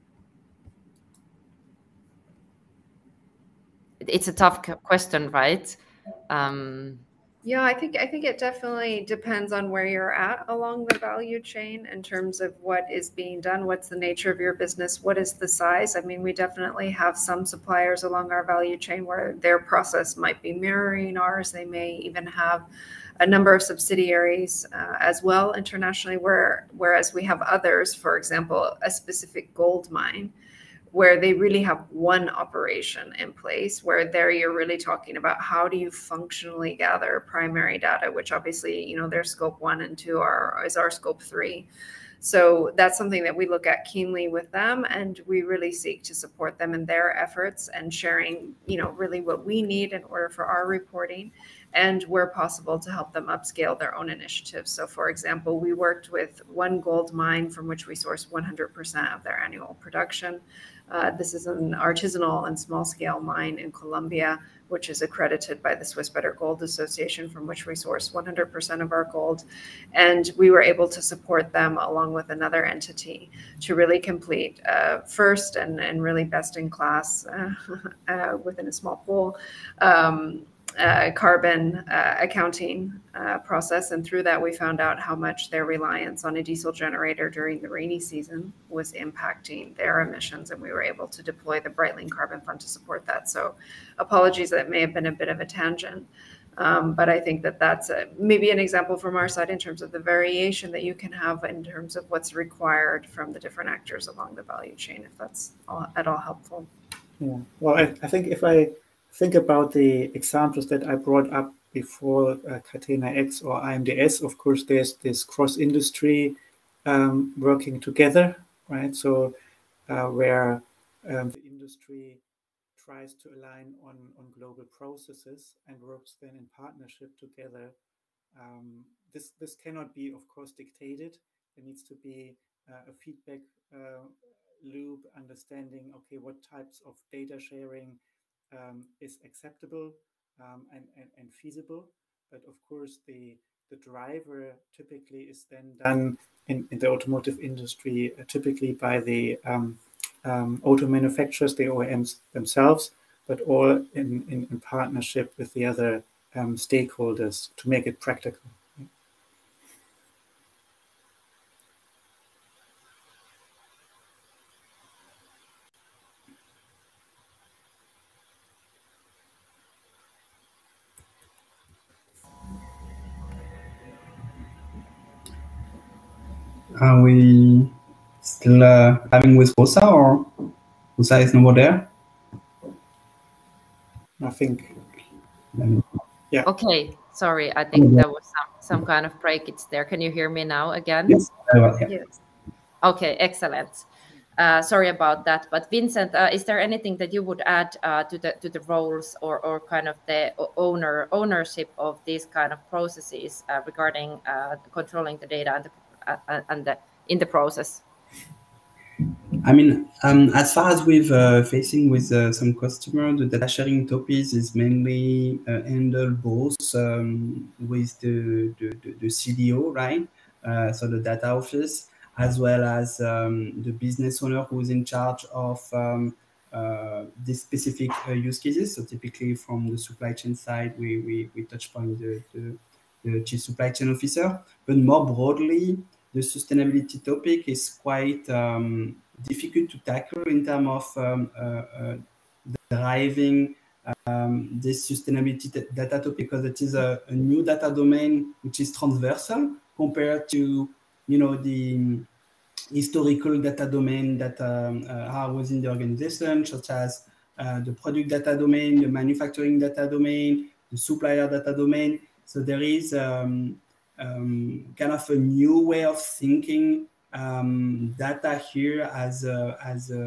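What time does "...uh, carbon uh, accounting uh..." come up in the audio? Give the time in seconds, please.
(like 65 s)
80 s.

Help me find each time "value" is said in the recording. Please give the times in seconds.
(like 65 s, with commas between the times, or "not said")
10 s, 18 s, 104 s.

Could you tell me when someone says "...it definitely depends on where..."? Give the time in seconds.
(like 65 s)
8 s.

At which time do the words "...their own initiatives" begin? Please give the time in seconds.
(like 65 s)
53 s.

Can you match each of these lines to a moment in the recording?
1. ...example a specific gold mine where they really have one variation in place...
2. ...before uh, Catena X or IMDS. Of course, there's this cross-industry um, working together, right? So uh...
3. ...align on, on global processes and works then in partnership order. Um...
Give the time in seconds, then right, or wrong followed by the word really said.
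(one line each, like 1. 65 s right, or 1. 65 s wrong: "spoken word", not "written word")
1. 28 s wrong: "operation", not "variation"
2. 111 s right
3. 123 s wrong: "together", not "order".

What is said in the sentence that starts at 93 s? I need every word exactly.
So, apologies, that may have been a bit of a tangent.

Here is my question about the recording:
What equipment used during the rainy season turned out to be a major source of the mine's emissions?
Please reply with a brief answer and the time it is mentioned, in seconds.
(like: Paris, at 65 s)
diesel generator, at 86 s.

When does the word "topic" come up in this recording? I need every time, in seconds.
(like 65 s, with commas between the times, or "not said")
213 s, 237 s, 246 s.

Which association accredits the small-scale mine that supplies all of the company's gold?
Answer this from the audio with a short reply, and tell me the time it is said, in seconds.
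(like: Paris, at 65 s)
Swiss Better Gold Association, at 65 s.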